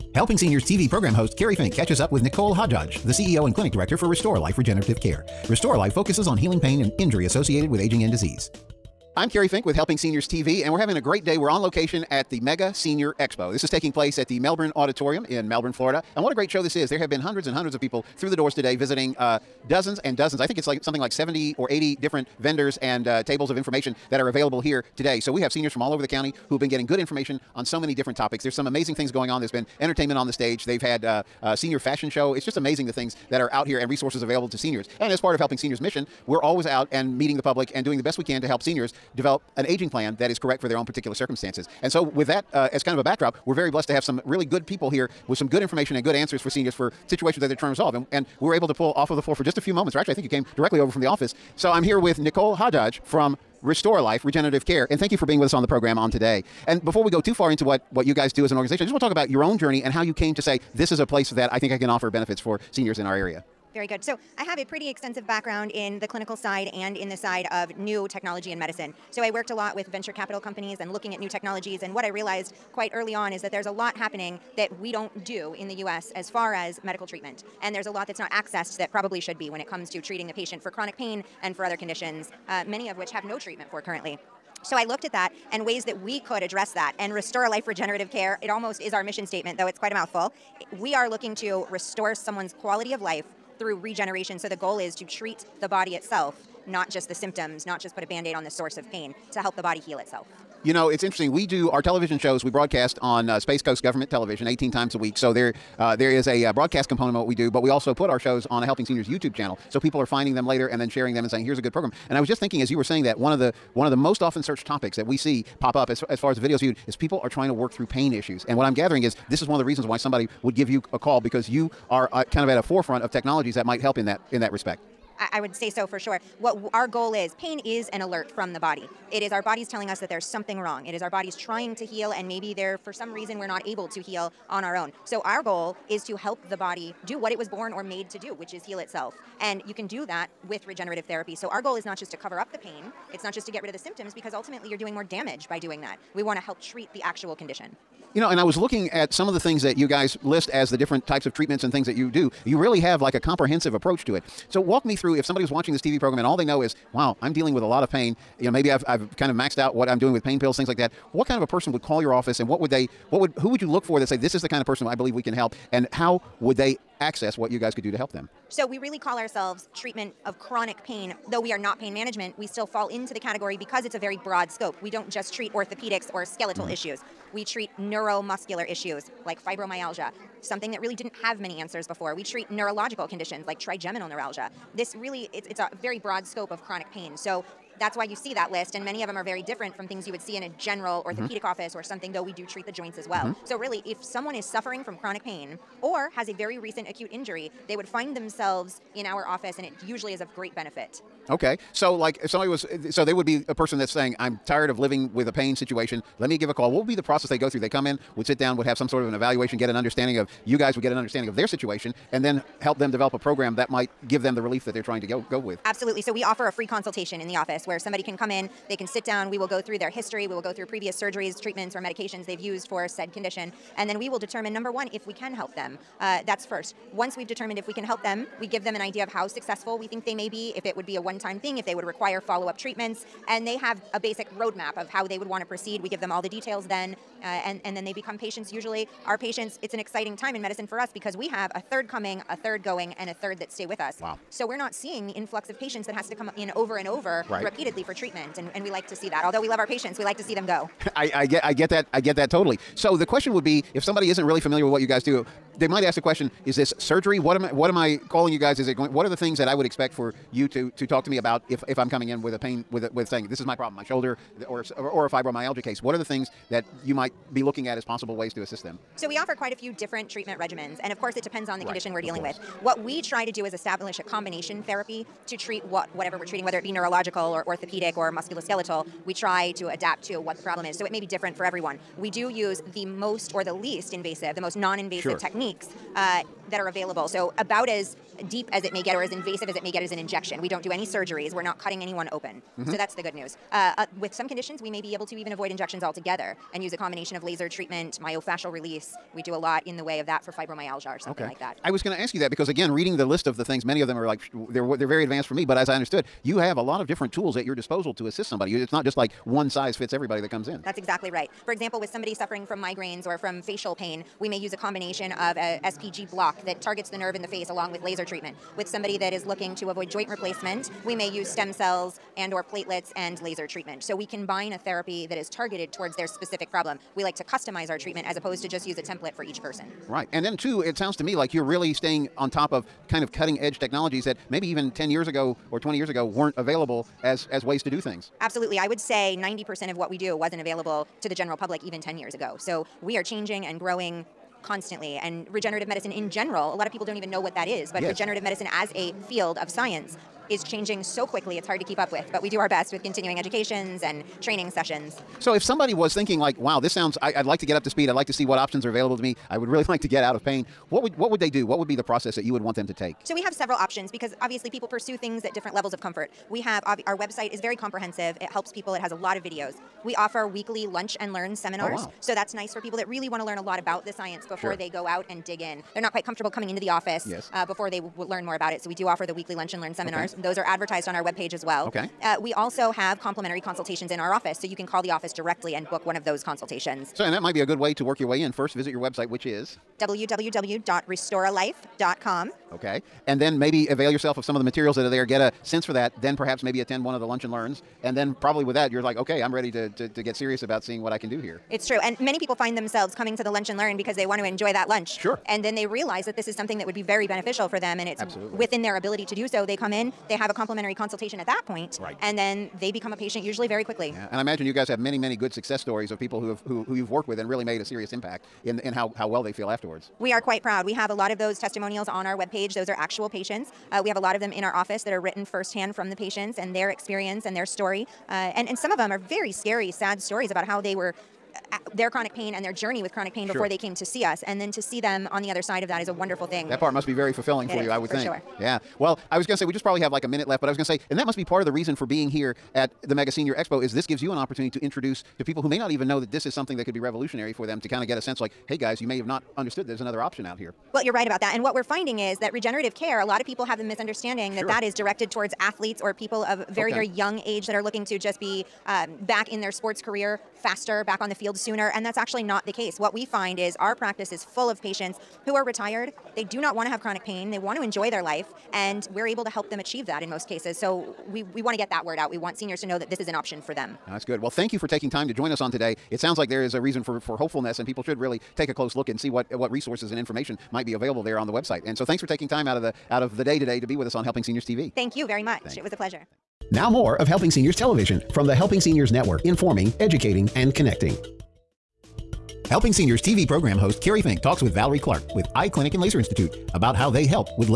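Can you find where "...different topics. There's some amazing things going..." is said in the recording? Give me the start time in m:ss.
0:27.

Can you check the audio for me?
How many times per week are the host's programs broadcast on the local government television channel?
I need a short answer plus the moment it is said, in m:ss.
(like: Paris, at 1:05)
18, at 1:44.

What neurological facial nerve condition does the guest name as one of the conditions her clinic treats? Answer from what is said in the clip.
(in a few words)
Trigeminal neuralgia.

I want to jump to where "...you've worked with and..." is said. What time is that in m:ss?
6:56.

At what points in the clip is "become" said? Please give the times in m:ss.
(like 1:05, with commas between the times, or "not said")
3:57, 6:52.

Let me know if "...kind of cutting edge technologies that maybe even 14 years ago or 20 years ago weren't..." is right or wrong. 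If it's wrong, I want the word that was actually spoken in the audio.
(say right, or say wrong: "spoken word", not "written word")
wrong: "10", not "14".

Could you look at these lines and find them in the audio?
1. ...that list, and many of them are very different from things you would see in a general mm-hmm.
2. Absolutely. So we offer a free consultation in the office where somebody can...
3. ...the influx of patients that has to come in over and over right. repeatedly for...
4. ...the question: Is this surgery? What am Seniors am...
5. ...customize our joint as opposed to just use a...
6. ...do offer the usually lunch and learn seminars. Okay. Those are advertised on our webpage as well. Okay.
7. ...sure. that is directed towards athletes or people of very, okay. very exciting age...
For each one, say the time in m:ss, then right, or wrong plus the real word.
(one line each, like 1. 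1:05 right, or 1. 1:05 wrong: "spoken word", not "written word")
1. 3:08 right
2. 3:35 right
3. 4:05 right
4. 4:15 wrong: "What", not "Seniors"
5. 5:27 wrong: "treatment", not "joint"
6. 6:18 wrong: "weekly", not "usually"
7. 7:34 wrong: "young", not "exciting".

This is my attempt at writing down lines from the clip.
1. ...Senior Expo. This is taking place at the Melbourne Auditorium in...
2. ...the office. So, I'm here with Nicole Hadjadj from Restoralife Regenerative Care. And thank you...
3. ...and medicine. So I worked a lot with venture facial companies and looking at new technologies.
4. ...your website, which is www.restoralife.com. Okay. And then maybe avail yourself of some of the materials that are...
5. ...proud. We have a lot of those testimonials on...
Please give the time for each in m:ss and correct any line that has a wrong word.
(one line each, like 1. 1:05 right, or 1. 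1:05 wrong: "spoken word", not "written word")
1. 0:12 right
2. 0:50 right
3. 1:08 wrong: "capital", not "facial"
4. 6:28 right
5. 7:00 right.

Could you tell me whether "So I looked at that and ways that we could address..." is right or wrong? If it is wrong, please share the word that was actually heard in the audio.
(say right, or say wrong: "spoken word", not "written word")
right.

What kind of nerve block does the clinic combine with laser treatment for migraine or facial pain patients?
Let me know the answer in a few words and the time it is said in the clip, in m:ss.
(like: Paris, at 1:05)
SPG block, at 5:15.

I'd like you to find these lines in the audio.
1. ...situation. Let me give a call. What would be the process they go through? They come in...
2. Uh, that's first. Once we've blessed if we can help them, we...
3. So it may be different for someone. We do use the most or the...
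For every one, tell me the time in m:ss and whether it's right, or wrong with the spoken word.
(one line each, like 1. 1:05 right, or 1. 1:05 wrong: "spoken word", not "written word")
1. 3:25 right
2. 3:46 wrong: "determined", not "blessed"
3. 4:40 wrong: "everyone", not "someone".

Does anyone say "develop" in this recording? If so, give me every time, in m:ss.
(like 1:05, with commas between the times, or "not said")
0:39, 3:32.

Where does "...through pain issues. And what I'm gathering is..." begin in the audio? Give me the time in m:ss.
1:57.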